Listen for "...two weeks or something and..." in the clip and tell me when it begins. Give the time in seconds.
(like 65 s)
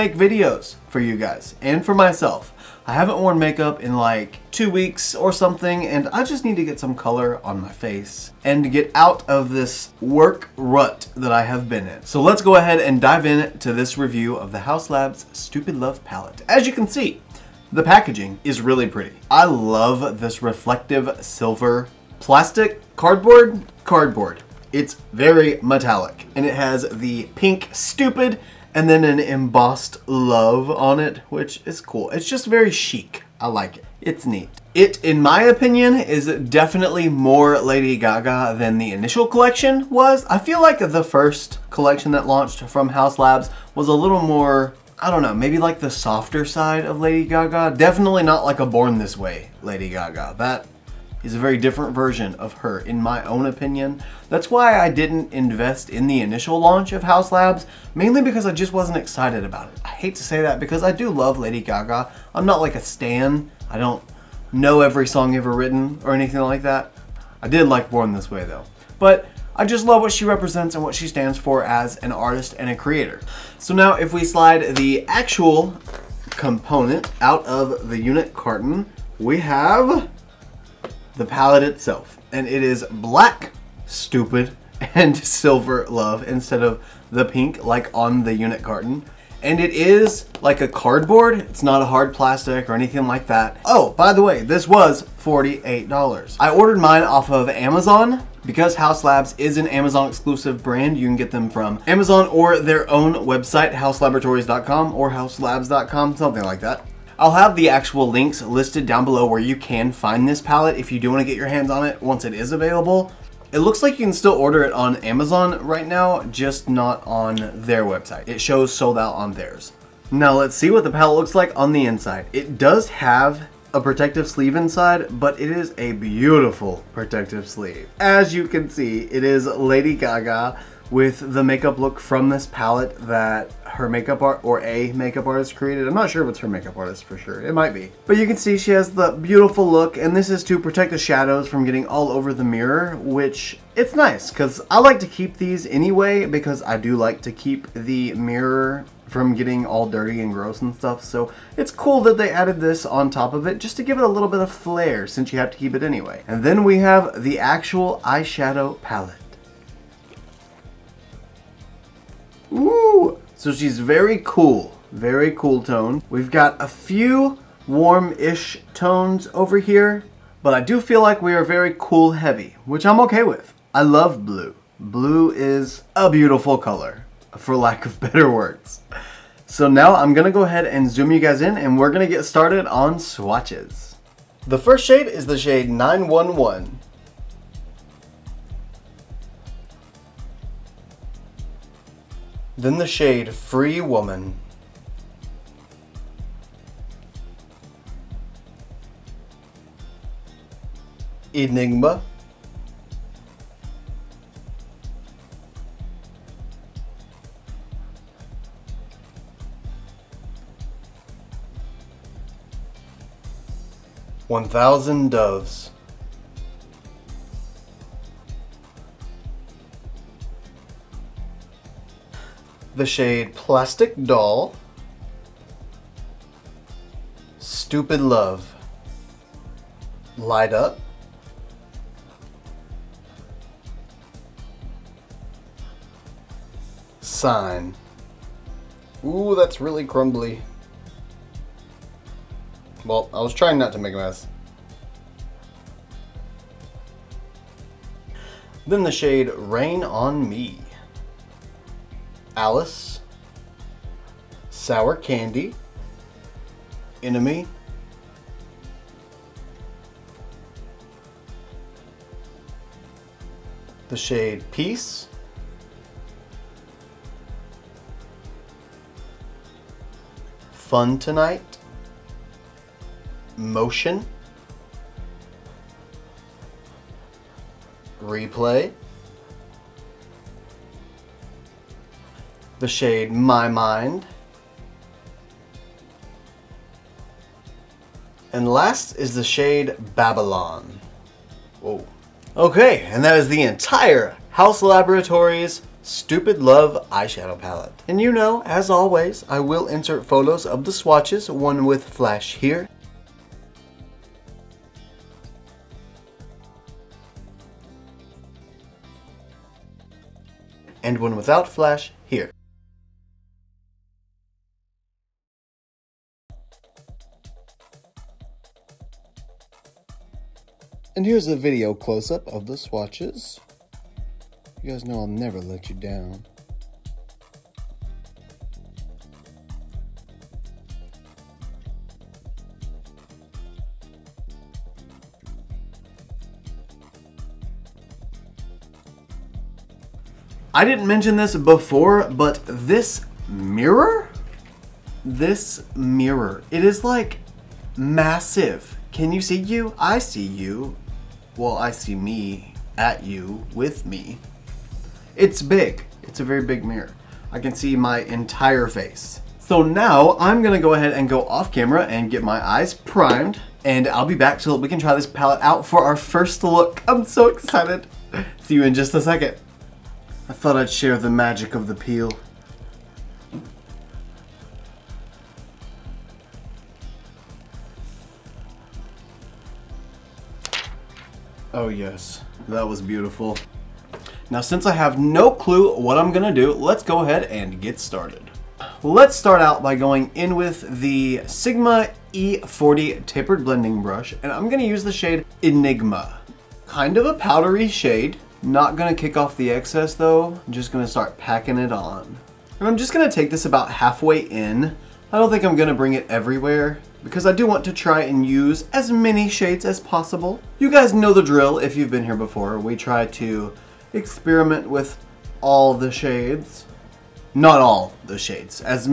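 4 s.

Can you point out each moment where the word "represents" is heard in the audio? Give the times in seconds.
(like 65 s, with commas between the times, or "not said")
70 s.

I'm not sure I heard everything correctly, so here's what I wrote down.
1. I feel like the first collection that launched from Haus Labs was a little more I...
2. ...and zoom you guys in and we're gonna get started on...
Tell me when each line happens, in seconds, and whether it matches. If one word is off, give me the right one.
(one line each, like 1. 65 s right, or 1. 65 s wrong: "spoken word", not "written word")
1. 40 s right
2. 180 s right.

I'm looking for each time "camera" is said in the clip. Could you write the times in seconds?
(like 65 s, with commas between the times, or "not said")
361 s.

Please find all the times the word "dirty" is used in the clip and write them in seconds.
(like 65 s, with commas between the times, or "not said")
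149 s.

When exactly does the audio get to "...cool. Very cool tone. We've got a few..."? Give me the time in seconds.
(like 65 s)
164 s.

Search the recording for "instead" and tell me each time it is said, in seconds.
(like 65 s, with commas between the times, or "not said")
86 s.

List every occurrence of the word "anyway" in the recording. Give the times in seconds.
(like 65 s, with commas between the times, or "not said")
145 s, 155 s.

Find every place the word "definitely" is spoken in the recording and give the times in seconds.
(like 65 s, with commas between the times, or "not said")
36 s, 47 s.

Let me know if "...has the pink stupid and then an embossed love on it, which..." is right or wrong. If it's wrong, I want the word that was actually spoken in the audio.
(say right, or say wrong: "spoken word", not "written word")
right.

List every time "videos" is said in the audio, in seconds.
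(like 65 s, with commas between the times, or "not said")
0 s, 321 s.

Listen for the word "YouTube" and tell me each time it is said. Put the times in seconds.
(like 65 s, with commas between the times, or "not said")
not said.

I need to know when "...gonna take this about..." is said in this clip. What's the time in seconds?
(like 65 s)
402 s.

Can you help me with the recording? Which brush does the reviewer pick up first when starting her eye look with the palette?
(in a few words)
Sigma E40 tapered blending brush.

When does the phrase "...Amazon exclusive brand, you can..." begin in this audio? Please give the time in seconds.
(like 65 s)
99 s.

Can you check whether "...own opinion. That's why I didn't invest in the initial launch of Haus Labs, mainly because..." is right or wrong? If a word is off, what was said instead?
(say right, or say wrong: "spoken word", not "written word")
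right.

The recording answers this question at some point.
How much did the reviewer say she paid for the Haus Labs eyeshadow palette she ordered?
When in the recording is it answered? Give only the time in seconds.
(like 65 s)
95 s.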